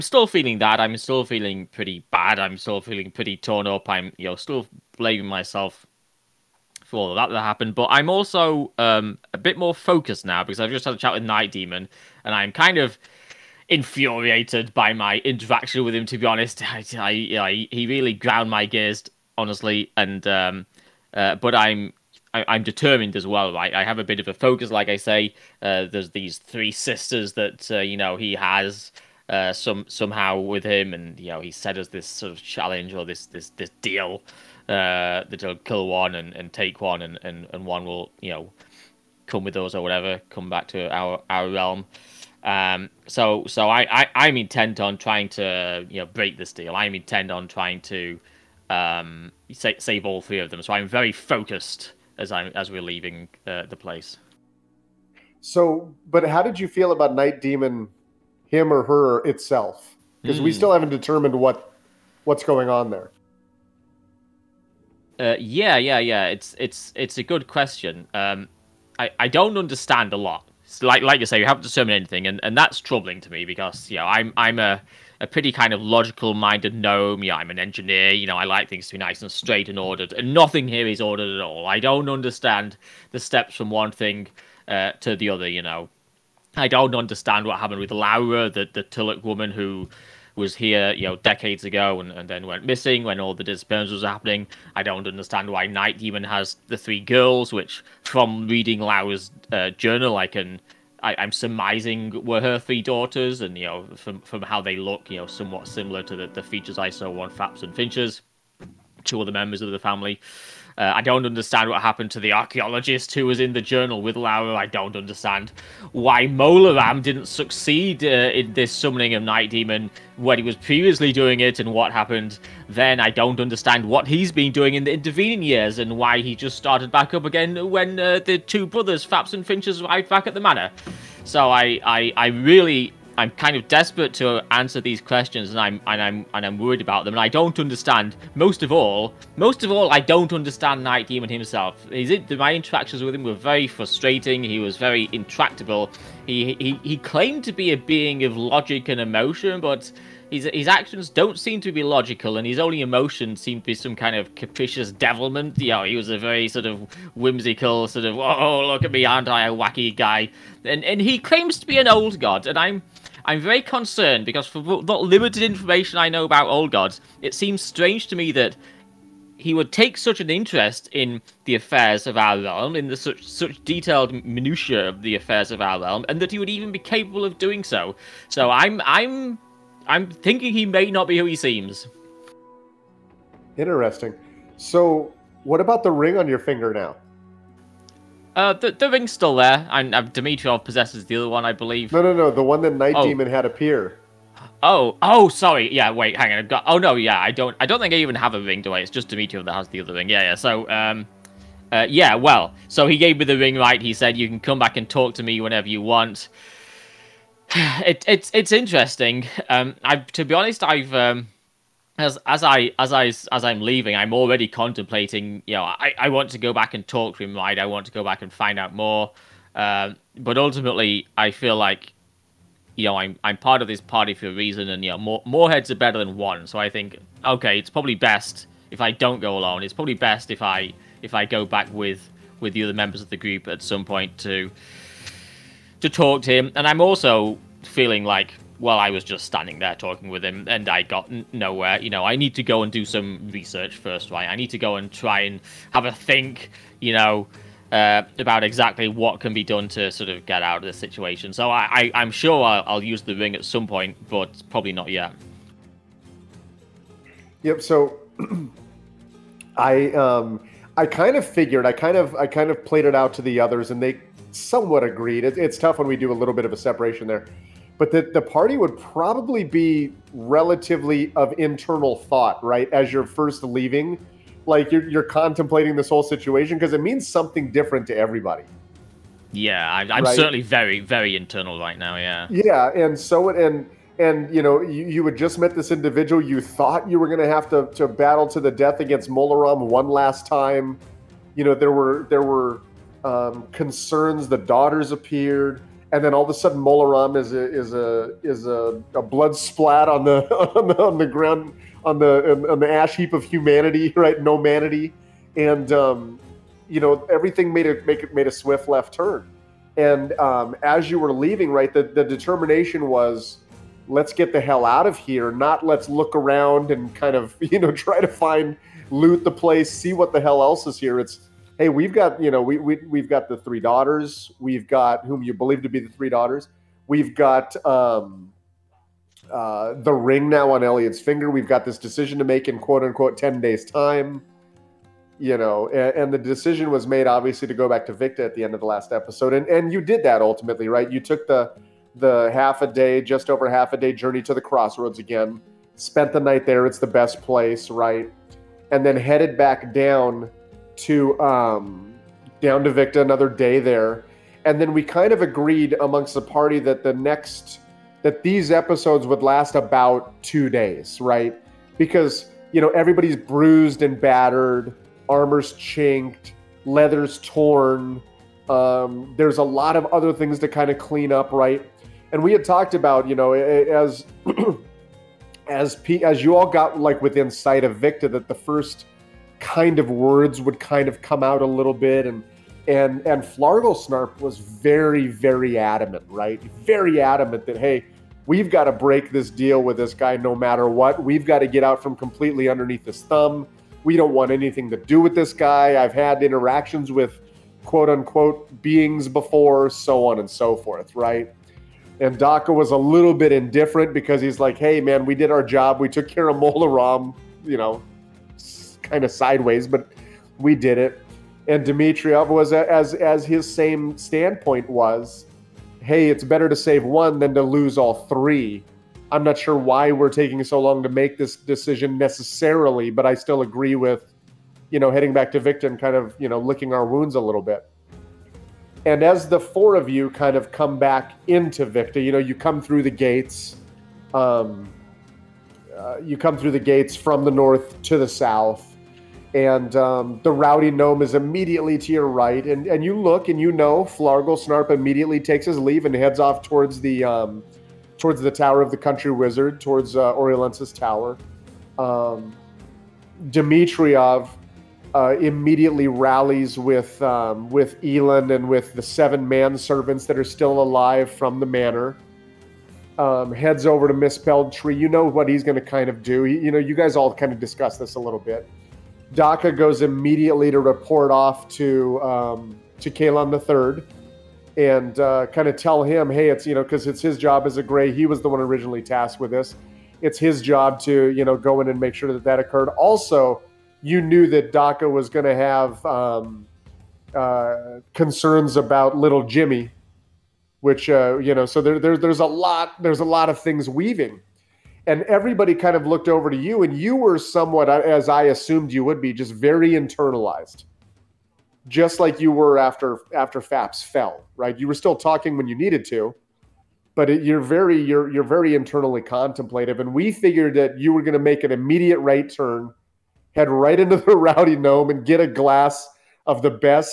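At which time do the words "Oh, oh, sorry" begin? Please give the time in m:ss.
3:14.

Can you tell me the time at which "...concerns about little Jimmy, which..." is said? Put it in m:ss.
8:07.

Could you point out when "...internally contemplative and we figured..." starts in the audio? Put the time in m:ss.
8:28.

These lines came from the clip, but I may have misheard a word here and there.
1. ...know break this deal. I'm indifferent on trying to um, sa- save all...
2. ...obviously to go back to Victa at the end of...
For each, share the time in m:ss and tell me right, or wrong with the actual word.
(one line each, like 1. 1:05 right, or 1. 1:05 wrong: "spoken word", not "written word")
1. 0:45 wrong: "intent", not "indifferent"
2. 5:37 right.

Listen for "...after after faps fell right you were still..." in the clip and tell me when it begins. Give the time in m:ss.
8:22.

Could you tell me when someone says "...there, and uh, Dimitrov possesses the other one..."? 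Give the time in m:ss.
3:09.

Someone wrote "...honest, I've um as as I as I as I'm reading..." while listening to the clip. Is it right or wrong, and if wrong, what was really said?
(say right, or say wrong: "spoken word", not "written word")
wrong: "leaving", not "reading".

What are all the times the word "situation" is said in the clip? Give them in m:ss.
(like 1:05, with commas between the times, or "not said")
4:10, 4:36.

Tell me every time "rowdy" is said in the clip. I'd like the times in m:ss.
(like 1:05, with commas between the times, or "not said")
7:20, 8:34.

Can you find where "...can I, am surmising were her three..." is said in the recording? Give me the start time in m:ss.
1:40.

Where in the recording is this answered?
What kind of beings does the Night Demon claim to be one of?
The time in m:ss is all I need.
2:41.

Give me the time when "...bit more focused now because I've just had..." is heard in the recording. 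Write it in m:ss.
0:09.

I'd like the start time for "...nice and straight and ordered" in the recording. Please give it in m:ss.
1:18.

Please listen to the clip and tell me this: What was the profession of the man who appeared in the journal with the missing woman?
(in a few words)
Archaeologist.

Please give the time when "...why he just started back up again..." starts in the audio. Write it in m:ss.
2:05.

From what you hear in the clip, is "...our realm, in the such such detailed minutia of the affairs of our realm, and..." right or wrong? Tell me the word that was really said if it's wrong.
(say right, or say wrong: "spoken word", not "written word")
right.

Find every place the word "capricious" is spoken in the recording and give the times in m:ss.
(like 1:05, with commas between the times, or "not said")
2:34.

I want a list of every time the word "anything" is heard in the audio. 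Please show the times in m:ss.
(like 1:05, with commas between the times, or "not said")
1:11, 6:34.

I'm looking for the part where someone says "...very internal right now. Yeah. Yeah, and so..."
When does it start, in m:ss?
4:40.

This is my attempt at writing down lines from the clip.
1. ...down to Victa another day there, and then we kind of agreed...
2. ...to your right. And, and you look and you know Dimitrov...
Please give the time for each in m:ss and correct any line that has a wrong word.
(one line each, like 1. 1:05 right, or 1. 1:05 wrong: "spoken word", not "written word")
1. 5:52 right
2. 7:21 wrong: "Flargle", not "Dimitrov".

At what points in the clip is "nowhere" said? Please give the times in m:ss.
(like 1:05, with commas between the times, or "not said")
4:01.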